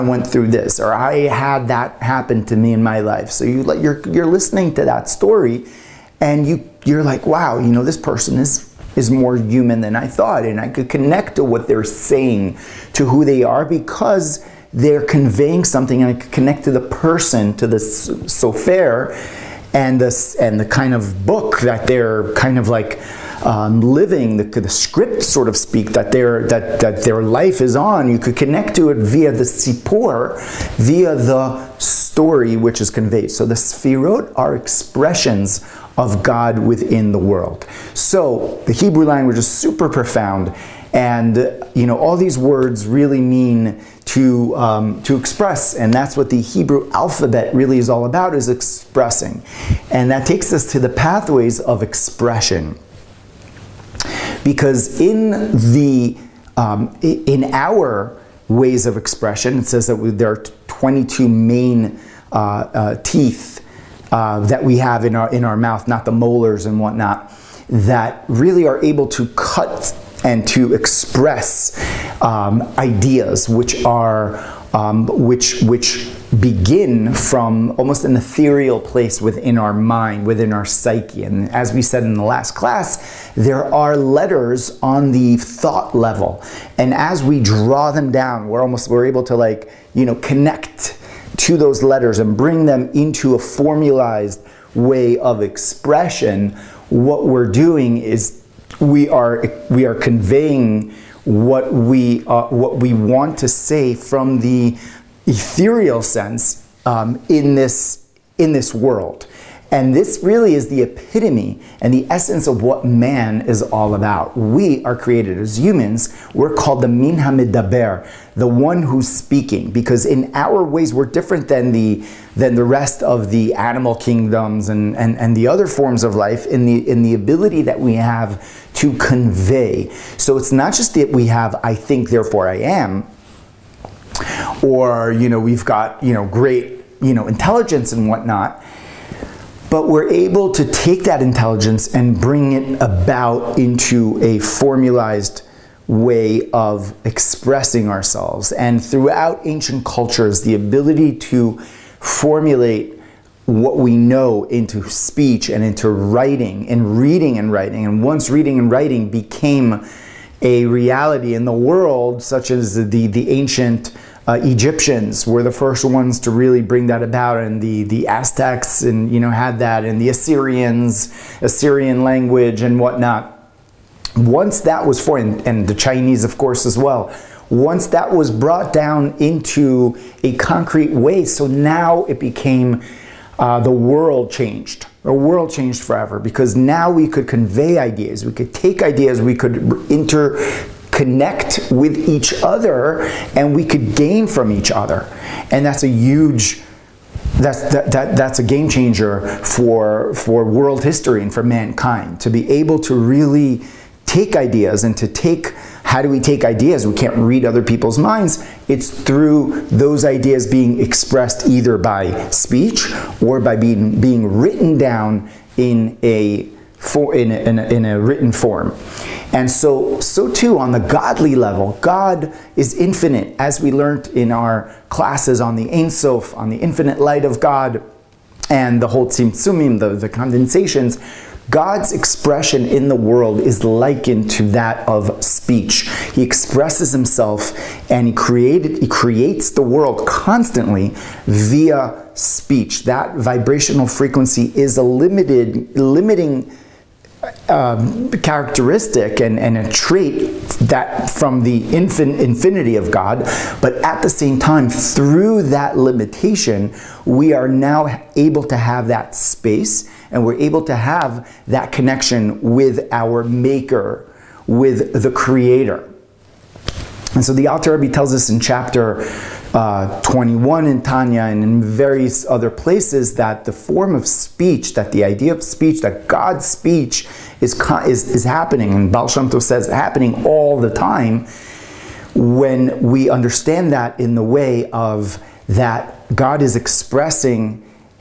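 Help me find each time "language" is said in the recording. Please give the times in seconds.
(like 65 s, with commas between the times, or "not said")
39 s, 172 s.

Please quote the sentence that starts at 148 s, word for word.
And throughout ancient cultures, the ability to formulate what we know into speech and into writing and reading and writing.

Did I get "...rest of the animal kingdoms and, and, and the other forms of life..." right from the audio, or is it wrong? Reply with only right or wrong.
right.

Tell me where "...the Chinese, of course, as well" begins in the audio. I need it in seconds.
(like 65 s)
175 s.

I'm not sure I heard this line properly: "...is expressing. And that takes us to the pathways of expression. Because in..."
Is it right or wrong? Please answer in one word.
right.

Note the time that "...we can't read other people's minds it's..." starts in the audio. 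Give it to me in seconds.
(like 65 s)
206 s.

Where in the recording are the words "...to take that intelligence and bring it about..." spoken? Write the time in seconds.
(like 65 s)
140 s.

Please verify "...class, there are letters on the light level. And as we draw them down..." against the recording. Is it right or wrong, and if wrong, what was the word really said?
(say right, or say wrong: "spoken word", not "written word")
wrong: "thought", not "light".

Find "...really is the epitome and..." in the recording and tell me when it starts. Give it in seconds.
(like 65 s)
110 s.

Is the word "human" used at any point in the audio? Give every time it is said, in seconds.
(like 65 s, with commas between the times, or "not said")
9 s, 115 s.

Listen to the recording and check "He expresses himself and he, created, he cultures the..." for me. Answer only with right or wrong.
wrong.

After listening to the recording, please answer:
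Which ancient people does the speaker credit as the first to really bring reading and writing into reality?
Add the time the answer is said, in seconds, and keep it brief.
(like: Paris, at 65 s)
Egyptians, at 164 s.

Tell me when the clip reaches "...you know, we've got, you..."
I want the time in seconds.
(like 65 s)
135 s.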